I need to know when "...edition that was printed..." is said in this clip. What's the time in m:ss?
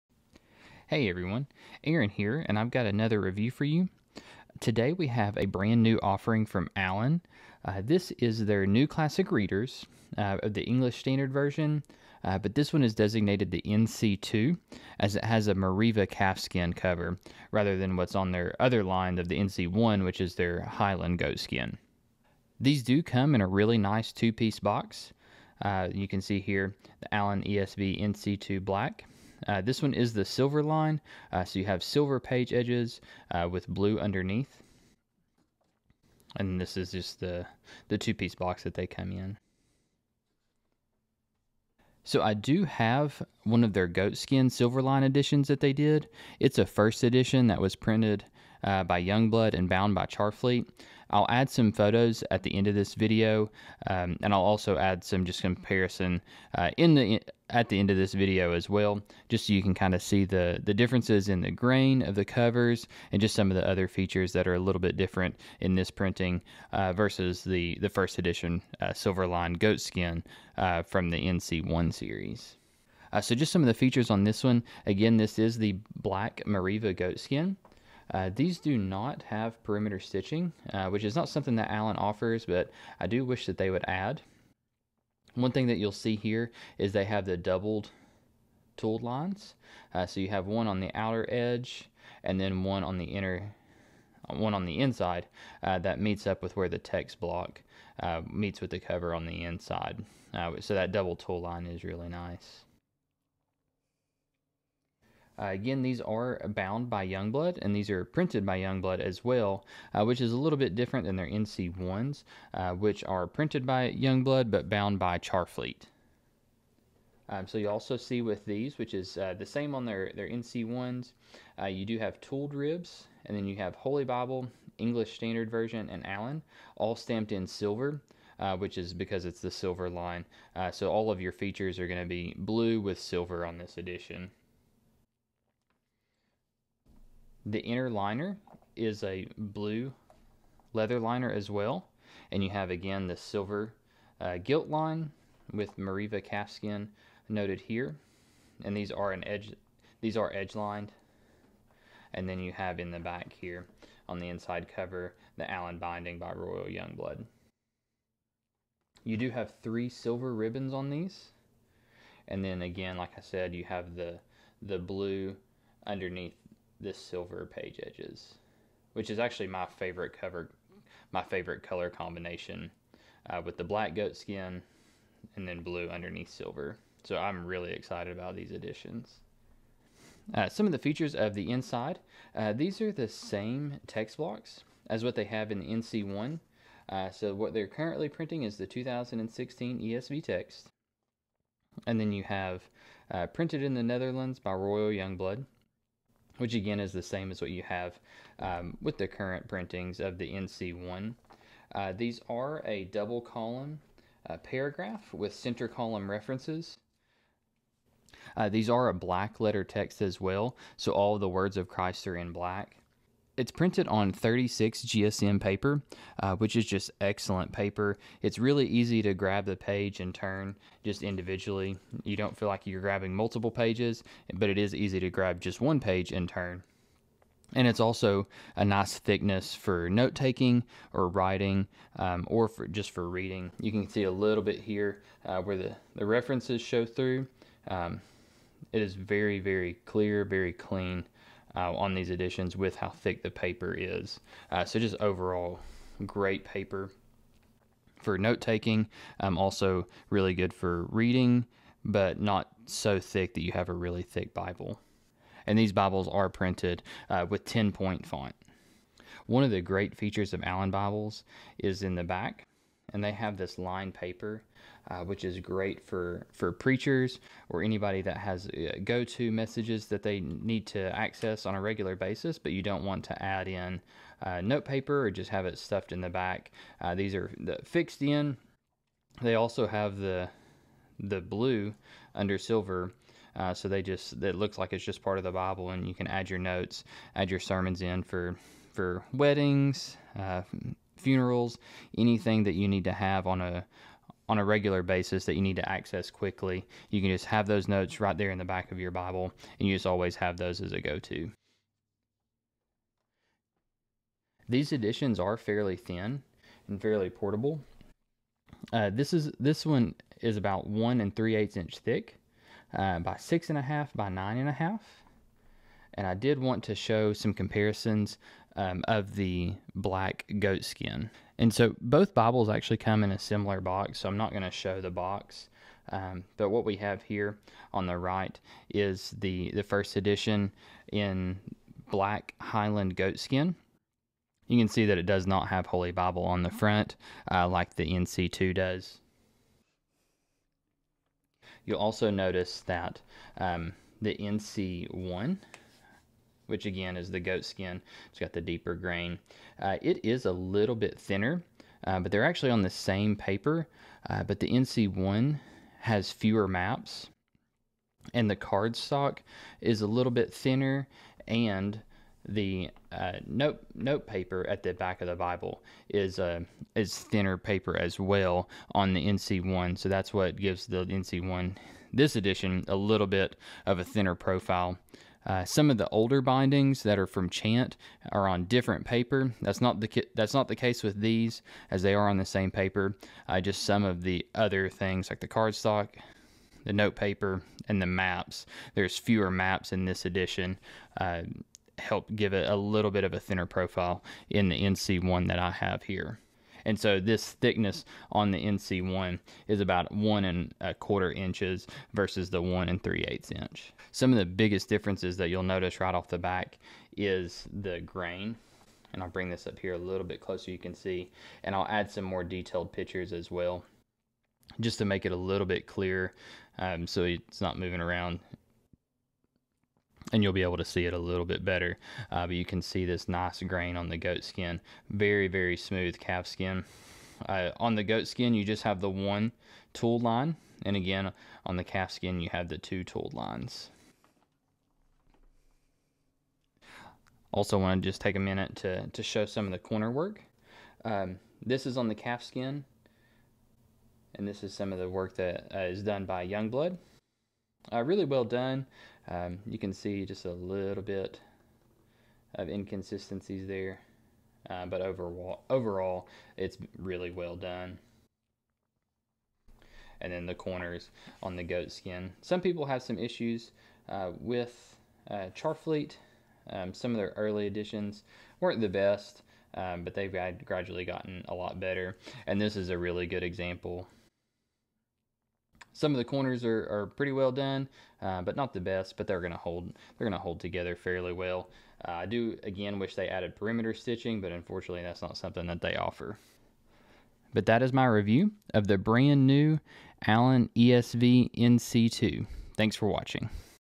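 0:47.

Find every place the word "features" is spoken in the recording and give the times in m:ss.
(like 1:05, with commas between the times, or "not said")
1:03, 1:13, 2:11, 3:00, 4:19.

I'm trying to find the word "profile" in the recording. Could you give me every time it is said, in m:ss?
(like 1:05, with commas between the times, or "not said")
6:14, 6:33.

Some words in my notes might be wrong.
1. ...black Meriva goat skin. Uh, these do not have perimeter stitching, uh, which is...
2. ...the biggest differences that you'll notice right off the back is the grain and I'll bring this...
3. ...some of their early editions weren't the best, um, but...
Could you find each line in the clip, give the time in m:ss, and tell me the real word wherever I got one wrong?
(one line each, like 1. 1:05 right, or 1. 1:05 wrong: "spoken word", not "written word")
1. 1:15 right
2. 6:44 right
3. 7:46 right.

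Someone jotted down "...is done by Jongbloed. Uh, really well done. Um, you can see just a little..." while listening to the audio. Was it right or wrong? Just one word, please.
right.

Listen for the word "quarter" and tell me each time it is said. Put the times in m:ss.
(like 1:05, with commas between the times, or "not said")
6:40.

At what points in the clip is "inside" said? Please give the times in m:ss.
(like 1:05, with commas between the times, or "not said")
1:34, 1:39, 2:34, 3:01.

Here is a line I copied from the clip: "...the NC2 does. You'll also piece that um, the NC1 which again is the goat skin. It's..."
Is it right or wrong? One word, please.
wrong.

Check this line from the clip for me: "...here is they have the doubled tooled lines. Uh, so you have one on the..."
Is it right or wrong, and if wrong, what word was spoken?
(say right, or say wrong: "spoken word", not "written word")
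right.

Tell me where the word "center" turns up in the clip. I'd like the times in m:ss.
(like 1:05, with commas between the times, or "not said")
3:25.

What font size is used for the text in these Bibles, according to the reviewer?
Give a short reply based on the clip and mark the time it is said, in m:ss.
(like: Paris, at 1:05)
10 point, at 4:17.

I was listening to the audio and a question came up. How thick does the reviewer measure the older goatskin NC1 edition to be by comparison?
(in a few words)
1 1/4 inches.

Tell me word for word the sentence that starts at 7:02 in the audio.
Uh, but you can see this nice grain on the goat skin.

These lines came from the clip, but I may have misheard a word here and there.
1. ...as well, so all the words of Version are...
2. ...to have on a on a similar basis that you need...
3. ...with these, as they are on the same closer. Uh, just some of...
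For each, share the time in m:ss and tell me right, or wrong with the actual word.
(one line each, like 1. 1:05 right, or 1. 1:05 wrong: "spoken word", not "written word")
1. 3:30 wrong: "Christ", not "Version"
2. 4:52 wrong: "regular", not "similar"
3. 6:20 wrong: "paper", not "closer".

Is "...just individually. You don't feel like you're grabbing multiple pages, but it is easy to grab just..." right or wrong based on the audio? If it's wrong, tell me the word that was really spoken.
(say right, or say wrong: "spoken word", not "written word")
right.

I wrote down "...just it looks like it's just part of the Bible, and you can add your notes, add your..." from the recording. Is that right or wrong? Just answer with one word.
right.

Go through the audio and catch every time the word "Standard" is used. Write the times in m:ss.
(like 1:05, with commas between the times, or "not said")
0:10, 2:05.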